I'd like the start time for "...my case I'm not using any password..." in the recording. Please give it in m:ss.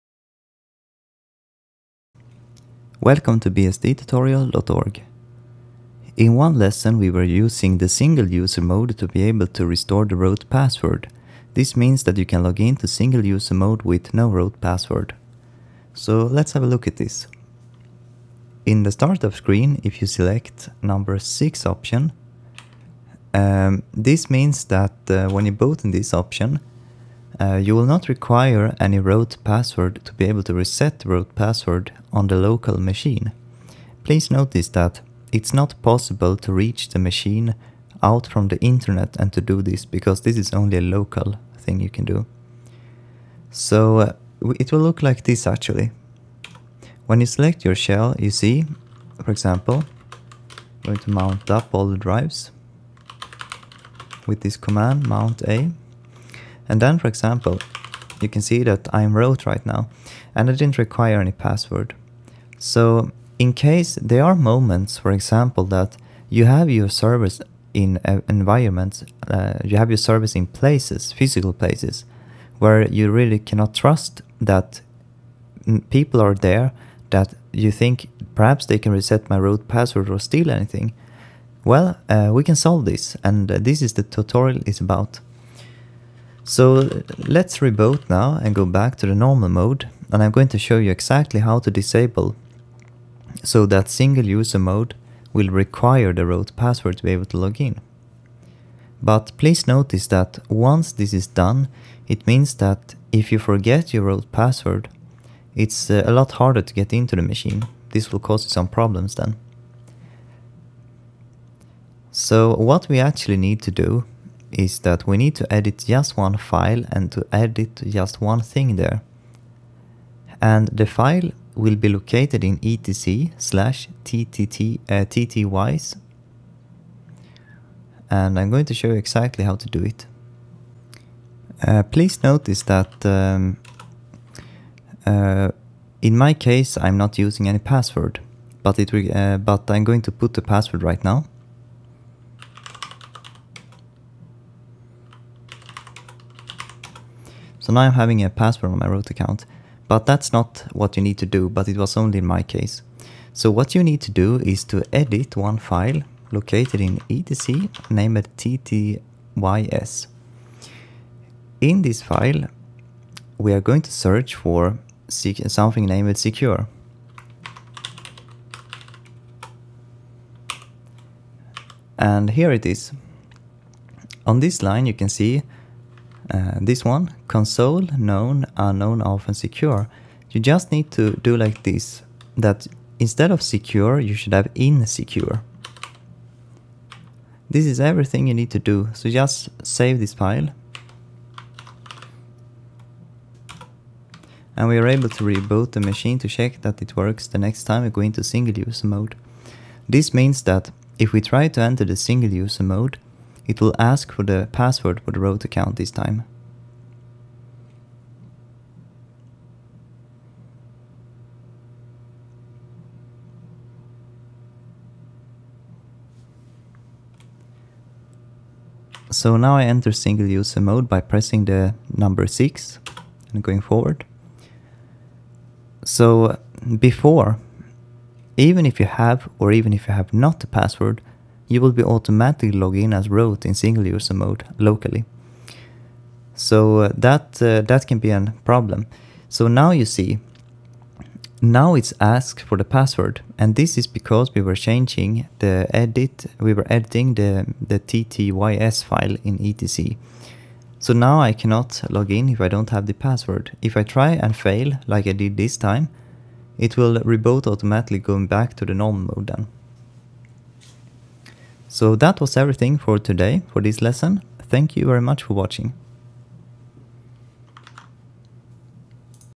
2:16.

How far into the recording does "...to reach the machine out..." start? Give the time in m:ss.
0:36.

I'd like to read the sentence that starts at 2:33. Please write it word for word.
So what you need to do is to edit one file located in etc, named ttys.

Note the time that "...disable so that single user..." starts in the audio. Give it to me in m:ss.
1:31.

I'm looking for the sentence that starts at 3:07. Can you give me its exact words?
This is everything you need to do, so just save this file.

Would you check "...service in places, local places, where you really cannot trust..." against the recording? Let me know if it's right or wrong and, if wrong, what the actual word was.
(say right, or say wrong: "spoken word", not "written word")
wrong: "physical", not "local".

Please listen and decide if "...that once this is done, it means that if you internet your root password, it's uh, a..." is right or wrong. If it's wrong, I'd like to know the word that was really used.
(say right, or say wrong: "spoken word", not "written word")
wrong: "forget", not "internet".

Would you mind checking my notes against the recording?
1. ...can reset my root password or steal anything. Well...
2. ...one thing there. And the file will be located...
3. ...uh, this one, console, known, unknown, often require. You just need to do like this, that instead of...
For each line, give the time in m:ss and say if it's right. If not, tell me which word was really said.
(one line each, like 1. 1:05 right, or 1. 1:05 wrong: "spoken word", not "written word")
1. 1:18 right
2. 1:58 right
3. 2:56 wrong: "secure", not "require".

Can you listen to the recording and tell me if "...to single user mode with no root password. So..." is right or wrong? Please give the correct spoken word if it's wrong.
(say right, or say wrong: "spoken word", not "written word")
right.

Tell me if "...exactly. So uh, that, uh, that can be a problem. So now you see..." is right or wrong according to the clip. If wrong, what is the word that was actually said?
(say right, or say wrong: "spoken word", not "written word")
wrong: "locally", not "exactly".